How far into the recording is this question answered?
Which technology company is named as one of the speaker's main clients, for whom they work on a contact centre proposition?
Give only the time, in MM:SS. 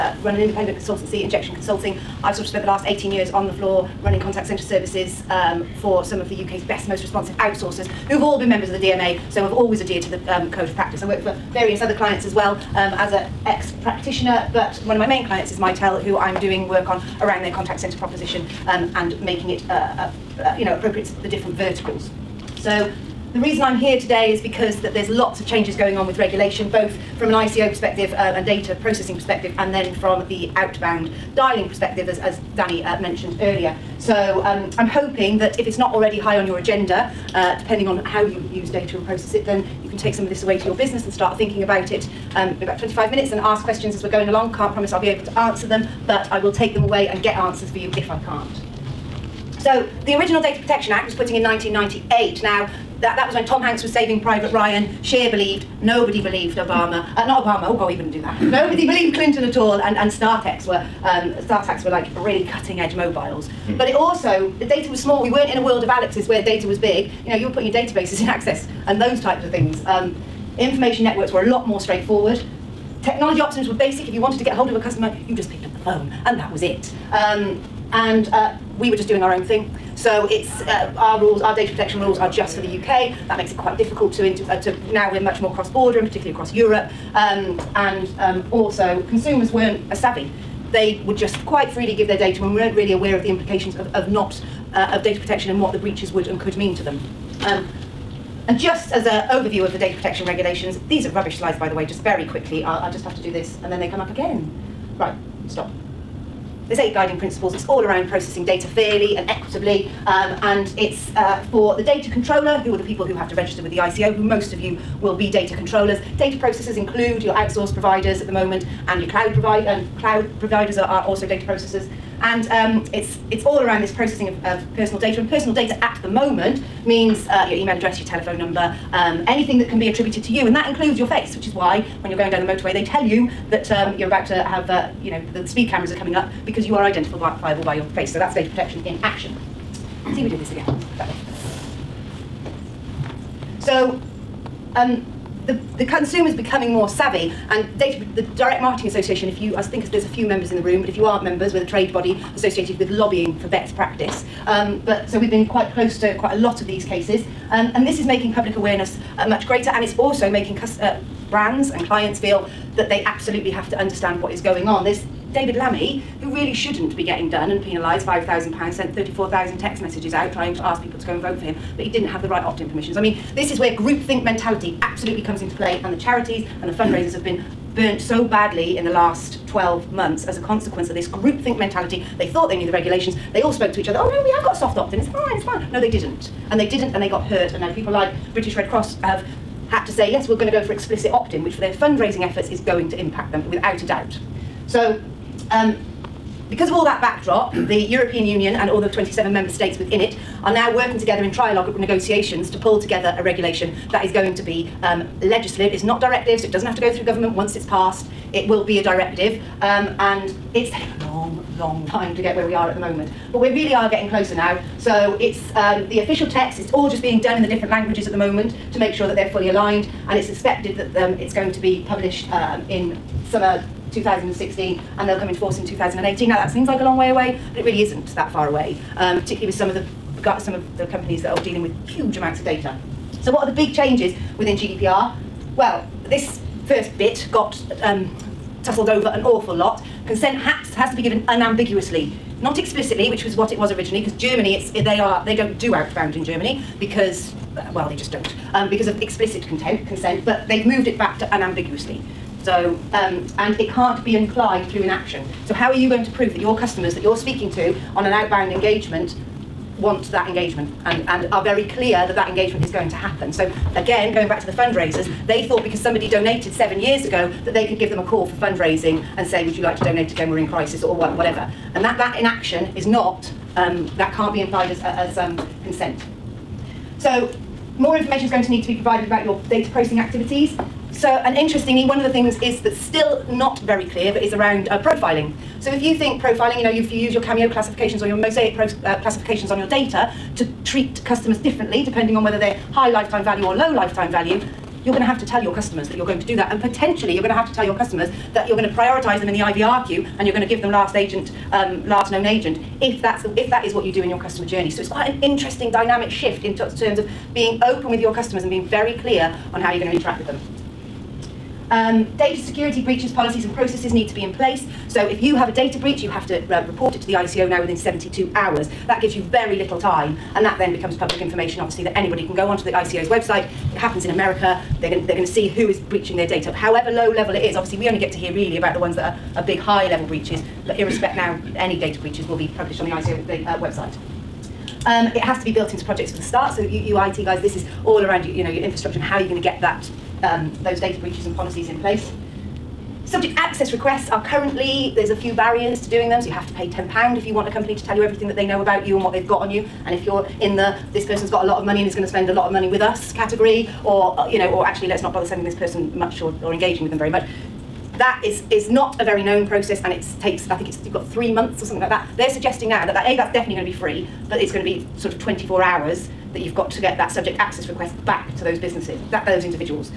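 00:15.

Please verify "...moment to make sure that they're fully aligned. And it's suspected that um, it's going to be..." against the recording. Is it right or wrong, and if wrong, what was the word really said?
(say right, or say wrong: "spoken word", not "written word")
right.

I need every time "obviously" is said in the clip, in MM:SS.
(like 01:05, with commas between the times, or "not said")
05:21, 05:27.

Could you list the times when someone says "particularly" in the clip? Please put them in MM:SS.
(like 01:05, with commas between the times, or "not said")
01:26, 03:49.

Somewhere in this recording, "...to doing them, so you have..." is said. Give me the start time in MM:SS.
05:45.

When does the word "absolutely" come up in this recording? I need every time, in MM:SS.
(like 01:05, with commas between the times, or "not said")
02:43, 02:54.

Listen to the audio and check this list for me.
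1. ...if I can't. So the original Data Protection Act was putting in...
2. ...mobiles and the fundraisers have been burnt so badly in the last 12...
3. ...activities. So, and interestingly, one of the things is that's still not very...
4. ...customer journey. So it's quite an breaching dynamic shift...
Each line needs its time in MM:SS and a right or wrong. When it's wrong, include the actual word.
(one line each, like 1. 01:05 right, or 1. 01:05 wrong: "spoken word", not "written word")
1. 00:47 right
2. 02:55 wrong: "charities", not "mobiles"
3. 04:39 right
4. 05:04 wrong: "interesting", not "breaching".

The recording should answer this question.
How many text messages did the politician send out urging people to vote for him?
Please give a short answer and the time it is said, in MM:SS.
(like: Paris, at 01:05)
34,000, at 02:48.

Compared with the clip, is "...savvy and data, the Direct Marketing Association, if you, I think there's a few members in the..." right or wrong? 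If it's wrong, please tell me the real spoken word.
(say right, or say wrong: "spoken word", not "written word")
right.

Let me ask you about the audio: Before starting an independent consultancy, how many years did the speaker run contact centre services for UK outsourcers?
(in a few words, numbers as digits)
18.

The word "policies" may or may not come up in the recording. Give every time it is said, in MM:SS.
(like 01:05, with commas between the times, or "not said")
05:13, 05:41.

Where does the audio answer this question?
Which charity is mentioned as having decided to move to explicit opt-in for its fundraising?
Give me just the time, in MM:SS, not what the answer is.
03:08.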